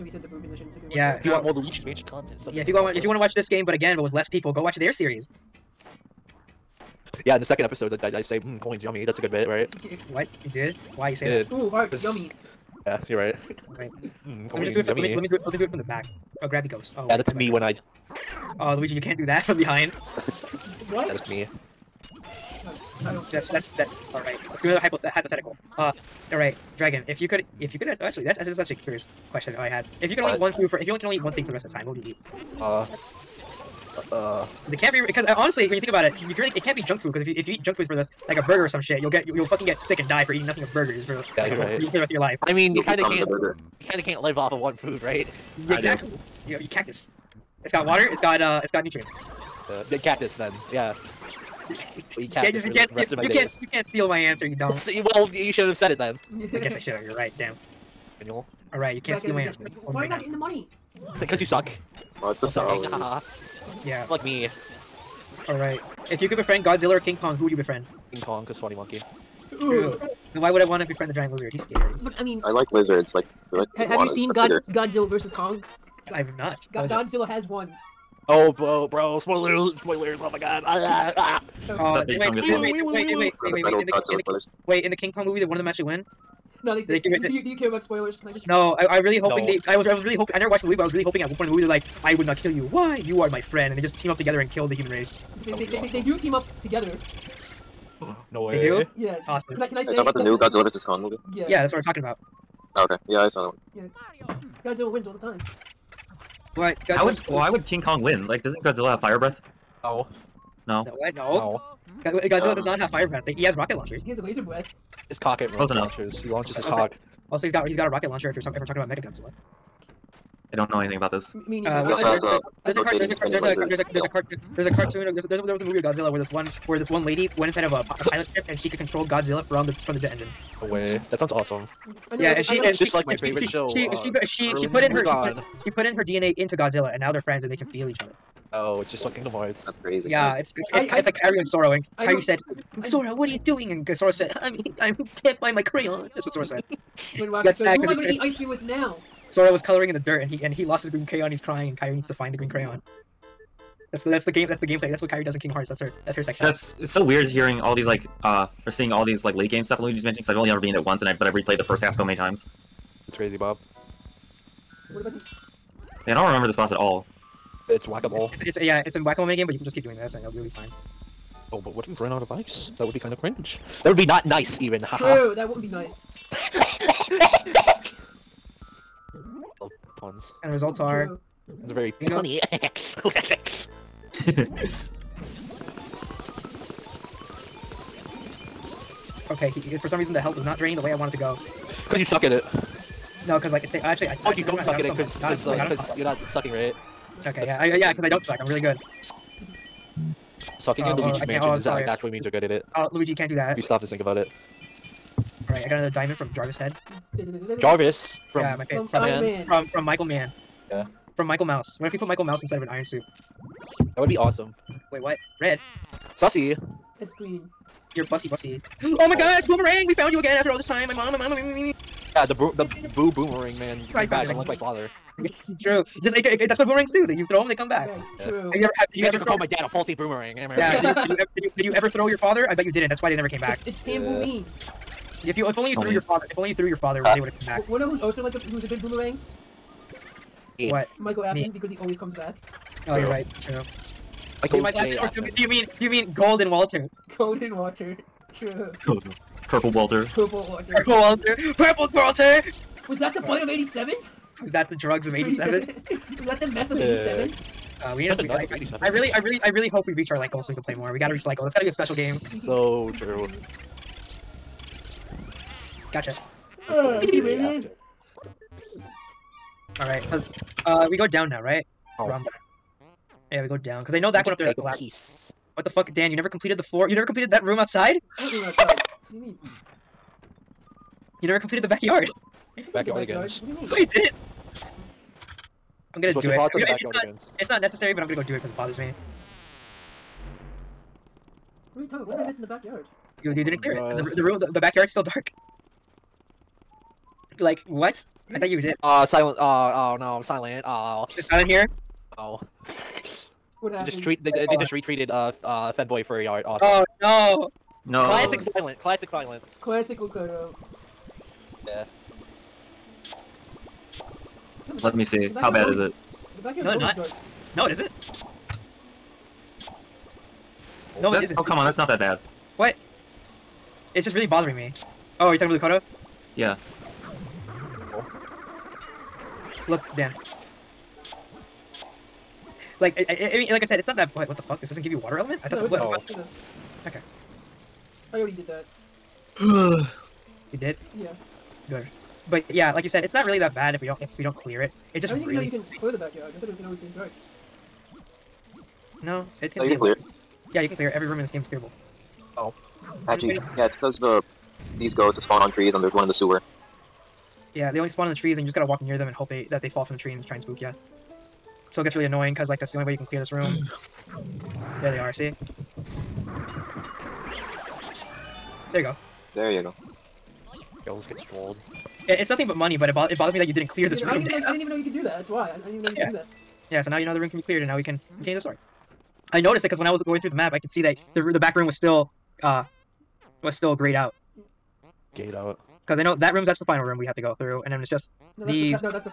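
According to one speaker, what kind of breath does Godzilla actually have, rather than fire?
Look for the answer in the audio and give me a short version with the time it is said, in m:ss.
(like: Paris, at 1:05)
laser breath, at 1:54.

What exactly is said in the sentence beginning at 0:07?
Yeah, in the second episode, I, I, I say, mm, coins, yummy.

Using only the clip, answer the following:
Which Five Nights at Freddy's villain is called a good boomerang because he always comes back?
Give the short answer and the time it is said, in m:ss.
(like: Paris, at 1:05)
Michael Afton, at 4:00.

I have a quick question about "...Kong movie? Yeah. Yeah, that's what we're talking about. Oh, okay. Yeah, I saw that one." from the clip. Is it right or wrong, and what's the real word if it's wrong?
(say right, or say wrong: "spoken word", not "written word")
right.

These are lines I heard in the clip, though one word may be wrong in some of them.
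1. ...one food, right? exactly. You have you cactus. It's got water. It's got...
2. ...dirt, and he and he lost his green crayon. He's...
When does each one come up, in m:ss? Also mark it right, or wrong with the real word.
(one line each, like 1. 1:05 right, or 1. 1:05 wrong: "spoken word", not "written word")
1. 0:44 right
2. 2:29 right.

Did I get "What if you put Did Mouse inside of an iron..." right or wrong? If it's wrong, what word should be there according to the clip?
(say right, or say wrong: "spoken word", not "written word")
wrong: "Michael", not "Did".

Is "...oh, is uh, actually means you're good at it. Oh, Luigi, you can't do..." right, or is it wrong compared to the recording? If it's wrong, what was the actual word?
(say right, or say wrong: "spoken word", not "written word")
right.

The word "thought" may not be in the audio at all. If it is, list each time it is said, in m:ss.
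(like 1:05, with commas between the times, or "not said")
4:58, 5:35, 5:46.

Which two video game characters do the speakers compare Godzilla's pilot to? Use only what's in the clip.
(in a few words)
Kairi and Sora.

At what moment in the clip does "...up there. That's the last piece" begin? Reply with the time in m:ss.
4:34.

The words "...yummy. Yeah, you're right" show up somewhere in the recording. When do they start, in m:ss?
0:12.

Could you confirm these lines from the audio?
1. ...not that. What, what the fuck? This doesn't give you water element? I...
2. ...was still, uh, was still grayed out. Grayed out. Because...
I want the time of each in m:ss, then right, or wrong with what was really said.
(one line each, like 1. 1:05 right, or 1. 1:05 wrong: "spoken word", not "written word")
1. 5:33 right
2. 6:21 right.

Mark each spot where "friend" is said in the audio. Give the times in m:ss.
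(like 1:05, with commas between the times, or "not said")
1:33, 2:17.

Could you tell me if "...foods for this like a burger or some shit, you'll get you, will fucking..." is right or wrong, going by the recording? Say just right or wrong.
right.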